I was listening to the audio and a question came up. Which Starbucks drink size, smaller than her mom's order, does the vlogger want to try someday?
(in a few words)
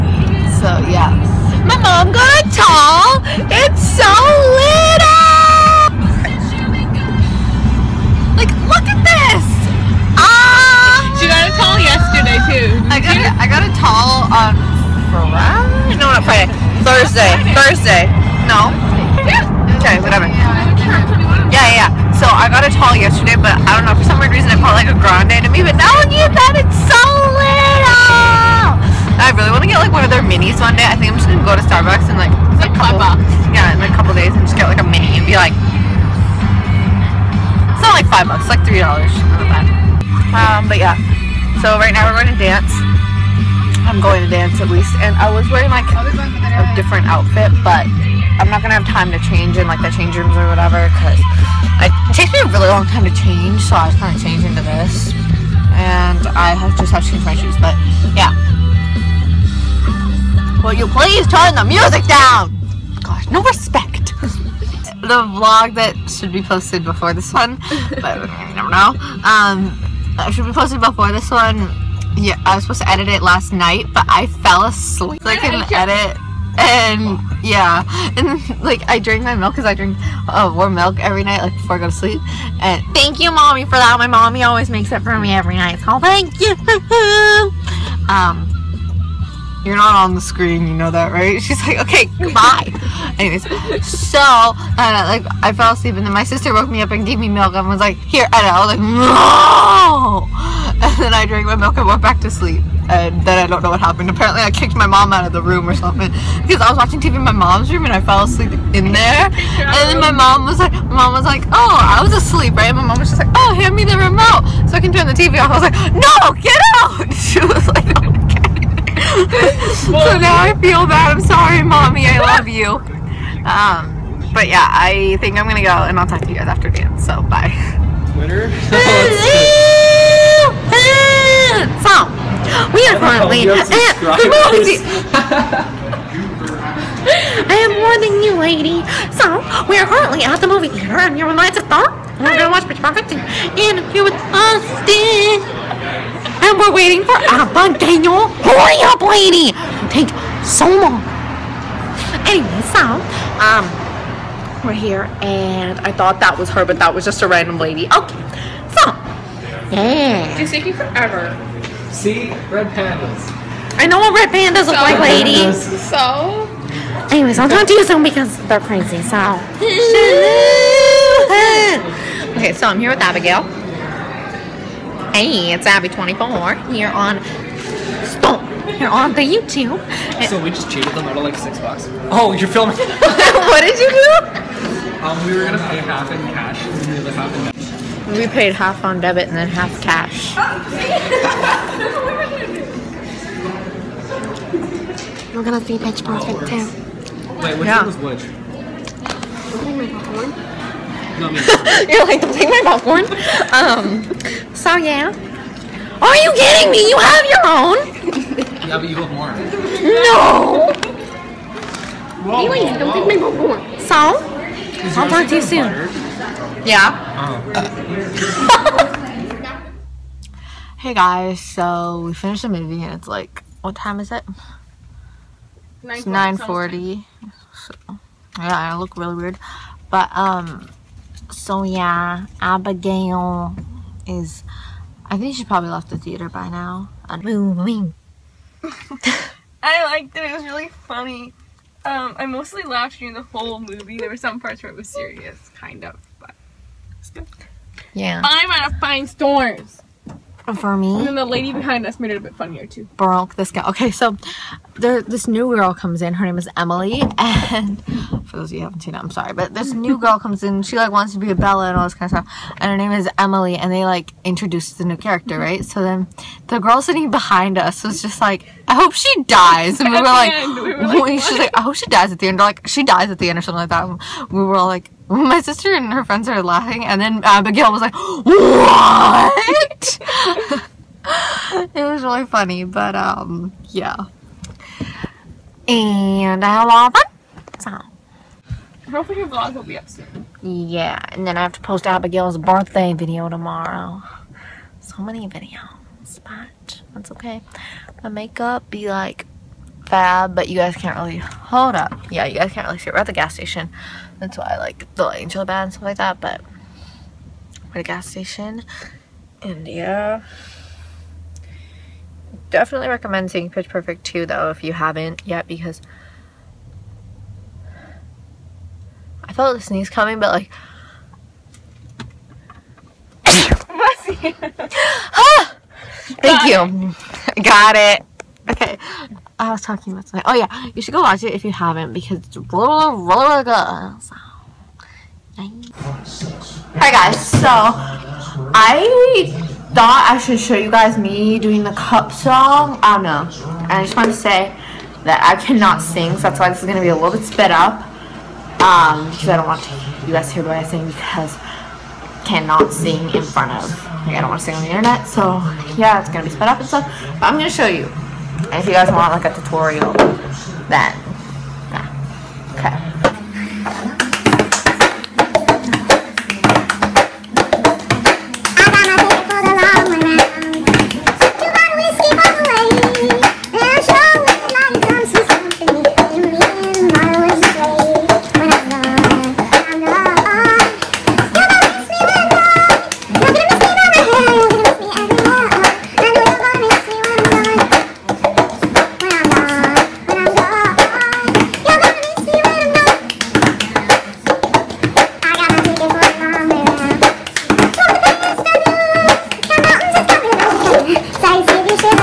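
mini.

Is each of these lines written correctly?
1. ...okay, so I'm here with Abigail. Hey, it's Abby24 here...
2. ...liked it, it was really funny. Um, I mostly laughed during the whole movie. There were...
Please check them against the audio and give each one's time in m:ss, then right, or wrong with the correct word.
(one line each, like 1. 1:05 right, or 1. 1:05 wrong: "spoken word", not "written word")
1. 2:52 right
2. 3:59 right.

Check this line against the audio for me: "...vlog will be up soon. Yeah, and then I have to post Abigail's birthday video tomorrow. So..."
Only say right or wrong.
right.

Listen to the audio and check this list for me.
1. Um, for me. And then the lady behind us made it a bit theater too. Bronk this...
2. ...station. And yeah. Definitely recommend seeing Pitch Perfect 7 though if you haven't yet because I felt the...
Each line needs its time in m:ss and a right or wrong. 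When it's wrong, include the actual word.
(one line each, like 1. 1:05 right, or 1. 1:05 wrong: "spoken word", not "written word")
1. 4:10 wrong: "funnier", not "theater"
2. 5:08 wrong: "2", not "7".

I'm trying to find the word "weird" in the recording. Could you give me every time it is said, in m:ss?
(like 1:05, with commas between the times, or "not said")
0:24, 3:49.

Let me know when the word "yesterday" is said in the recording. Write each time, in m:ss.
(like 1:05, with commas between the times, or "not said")
0:11, 0:22.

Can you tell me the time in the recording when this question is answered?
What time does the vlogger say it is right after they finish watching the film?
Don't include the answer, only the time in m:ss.
3:46.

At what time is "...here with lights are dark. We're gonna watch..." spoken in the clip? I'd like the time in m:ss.
2:21.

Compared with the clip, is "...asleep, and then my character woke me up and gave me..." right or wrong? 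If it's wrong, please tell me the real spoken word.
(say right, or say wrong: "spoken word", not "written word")
wrong: "sister", not "character".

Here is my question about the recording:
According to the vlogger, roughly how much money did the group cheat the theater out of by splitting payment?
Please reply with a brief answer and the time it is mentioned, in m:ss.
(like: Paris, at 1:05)
6 dollars, at 3:01.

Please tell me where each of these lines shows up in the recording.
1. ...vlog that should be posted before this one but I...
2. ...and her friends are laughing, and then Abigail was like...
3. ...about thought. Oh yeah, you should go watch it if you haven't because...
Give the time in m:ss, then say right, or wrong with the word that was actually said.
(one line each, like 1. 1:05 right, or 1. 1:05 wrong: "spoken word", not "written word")
1. 1:05 right
2. 4:35 right
3. 5:29 wrong: "tonight", not "thought".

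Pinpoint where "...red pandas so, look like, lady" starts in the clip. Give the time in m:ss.
2:44.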